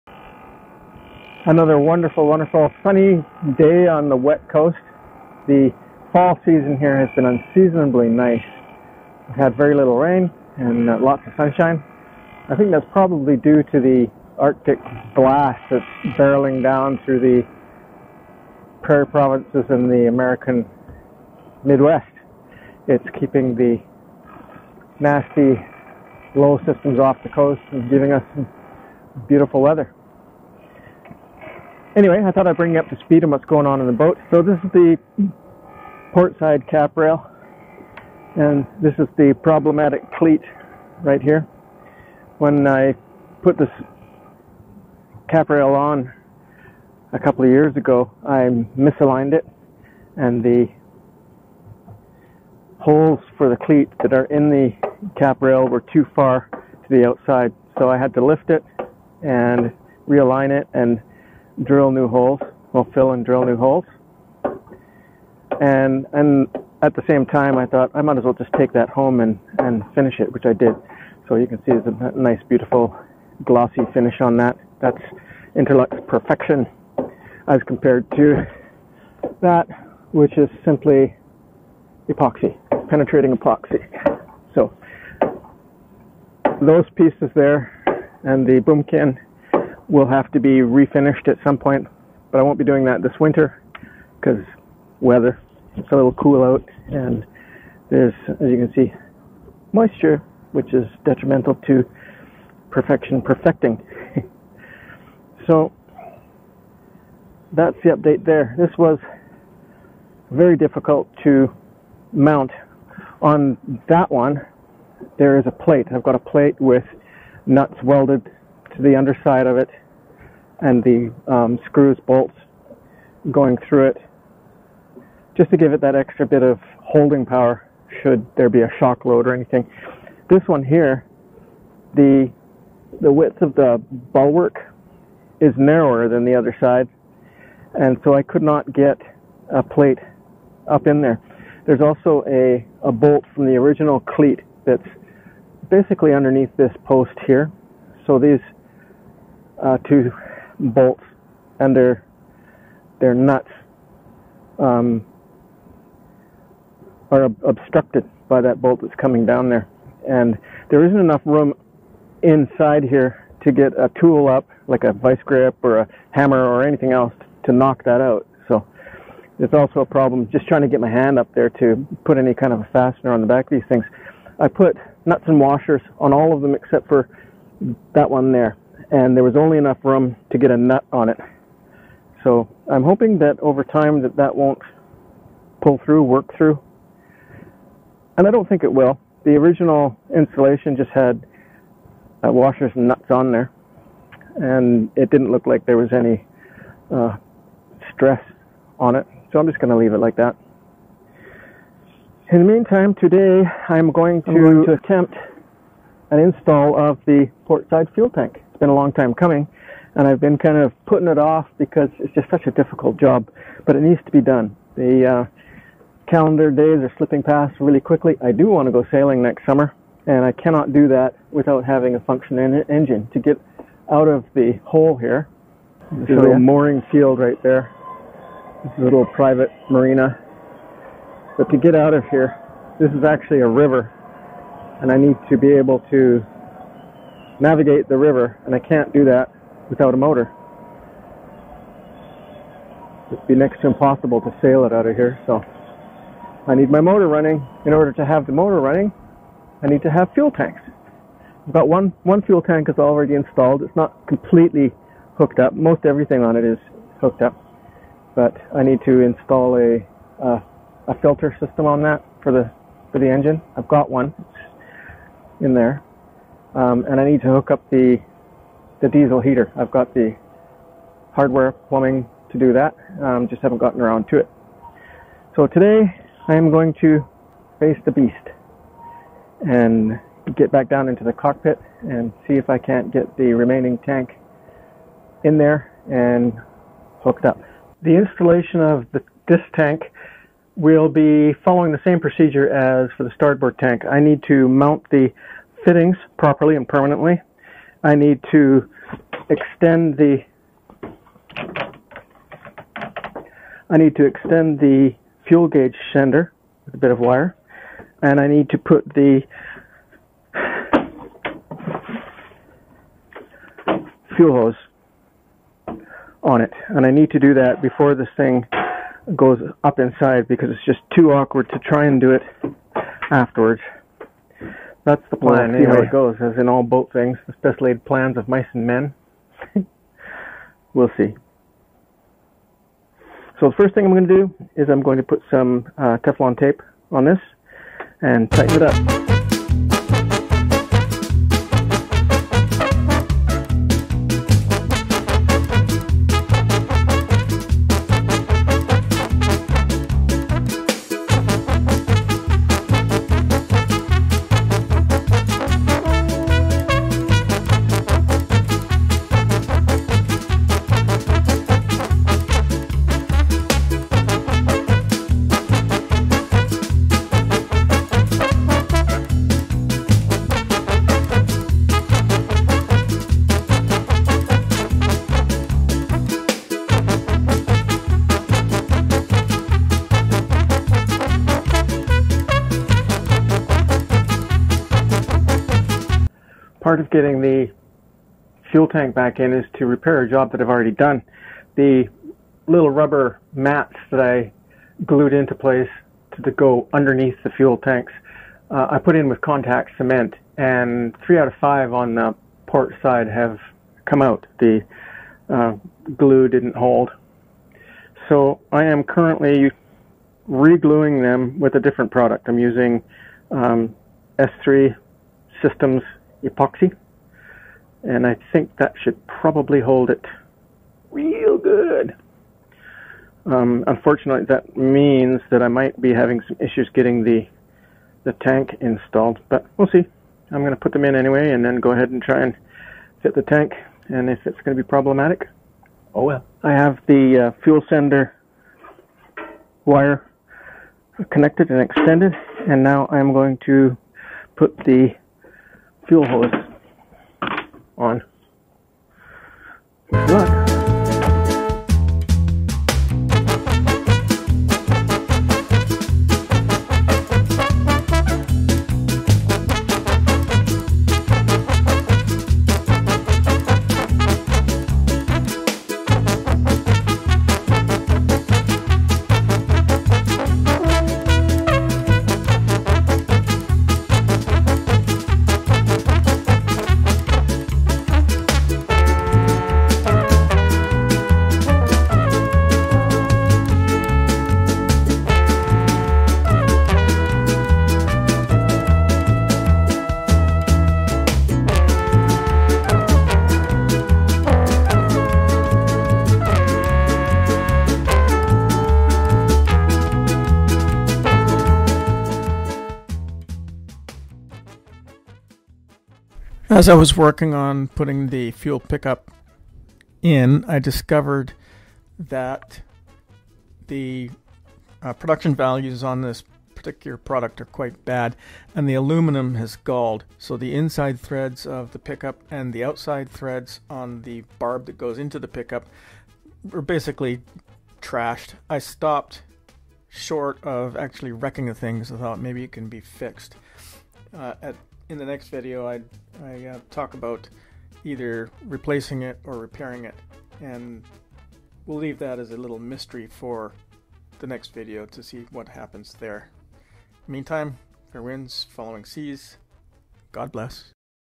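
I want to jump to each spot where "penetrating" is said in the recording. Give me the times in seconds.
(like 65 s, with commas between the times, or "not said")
82 s.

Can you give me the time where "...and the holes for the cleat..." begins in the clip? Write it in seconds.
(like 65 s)
50 s.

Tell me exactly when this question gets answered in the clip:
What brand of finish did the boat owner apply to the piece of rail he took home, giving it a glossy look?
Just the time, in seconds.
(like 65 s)
75 s.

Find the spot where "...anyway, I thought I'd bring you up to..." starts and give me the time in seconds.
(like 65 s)
31 s.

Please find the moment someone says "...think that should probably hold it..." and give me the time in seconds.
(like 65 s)
418 s.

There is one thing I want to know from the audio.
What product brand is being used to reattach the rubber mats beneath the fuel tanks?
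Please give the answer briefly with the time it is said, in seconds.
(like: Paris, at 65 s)
S3 Systems epoxy, at 414 s.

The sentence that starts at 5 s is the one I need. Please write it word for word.
The fall season here has been unseasonably nice.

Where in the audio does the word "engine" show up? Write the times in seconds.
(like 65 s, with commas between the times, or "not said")
222 s, 263 s.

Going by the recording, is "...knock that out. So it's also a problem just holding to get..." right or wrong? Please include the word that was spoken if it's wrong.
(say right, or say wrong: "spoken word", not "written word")
wrong: "trying", not "holding".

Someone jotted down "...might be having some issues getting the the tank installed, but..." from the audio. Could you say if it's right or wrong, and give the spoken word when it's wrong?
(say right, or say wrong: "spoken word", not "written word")
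right.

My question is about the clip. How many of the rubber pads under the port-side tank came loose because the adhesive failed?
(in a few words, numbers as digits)
3.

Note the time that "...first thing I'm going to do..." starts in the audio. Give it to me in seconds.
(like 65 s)
333 s.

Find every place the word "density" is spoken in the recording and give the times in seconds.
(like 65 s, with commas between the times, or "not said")
not said.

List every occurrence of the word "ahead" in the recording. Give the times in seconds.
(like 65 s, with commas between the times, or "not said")
431 s.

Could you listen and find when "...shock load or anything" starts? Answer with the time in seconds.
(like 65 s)
128 s.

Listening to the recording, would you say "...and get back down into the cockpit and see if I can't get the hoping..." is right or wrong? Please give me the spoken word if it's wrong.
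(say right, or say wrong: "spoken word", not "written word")
wrong: "remaining", not "hoping".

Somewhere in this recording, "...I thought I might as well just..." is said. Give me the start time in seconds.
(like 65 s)
67 s.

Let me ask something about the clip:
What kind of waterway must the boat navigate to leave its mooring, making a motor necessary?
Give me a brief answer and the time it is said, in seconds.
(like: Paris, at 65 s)
a river, at 233 s.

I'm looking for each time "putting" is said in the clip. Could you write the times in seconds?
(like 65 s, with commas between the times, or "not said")
210 s, 507 s.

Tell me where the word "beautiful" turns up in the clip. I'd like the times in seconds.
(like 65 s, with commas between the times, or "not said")
29 s, 72 s.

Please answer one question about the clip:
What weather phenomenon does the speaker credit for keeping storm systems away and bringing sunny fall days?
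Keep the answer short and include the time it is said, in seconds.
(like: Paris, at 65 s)
Arctic blast, at 14 s.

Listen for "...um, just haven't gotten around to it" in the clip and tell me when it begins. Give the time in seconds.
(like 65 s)
273 s.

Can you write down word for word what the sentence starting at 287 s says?
The installation of the, this tank will be following the same procedure as for the starboard tank.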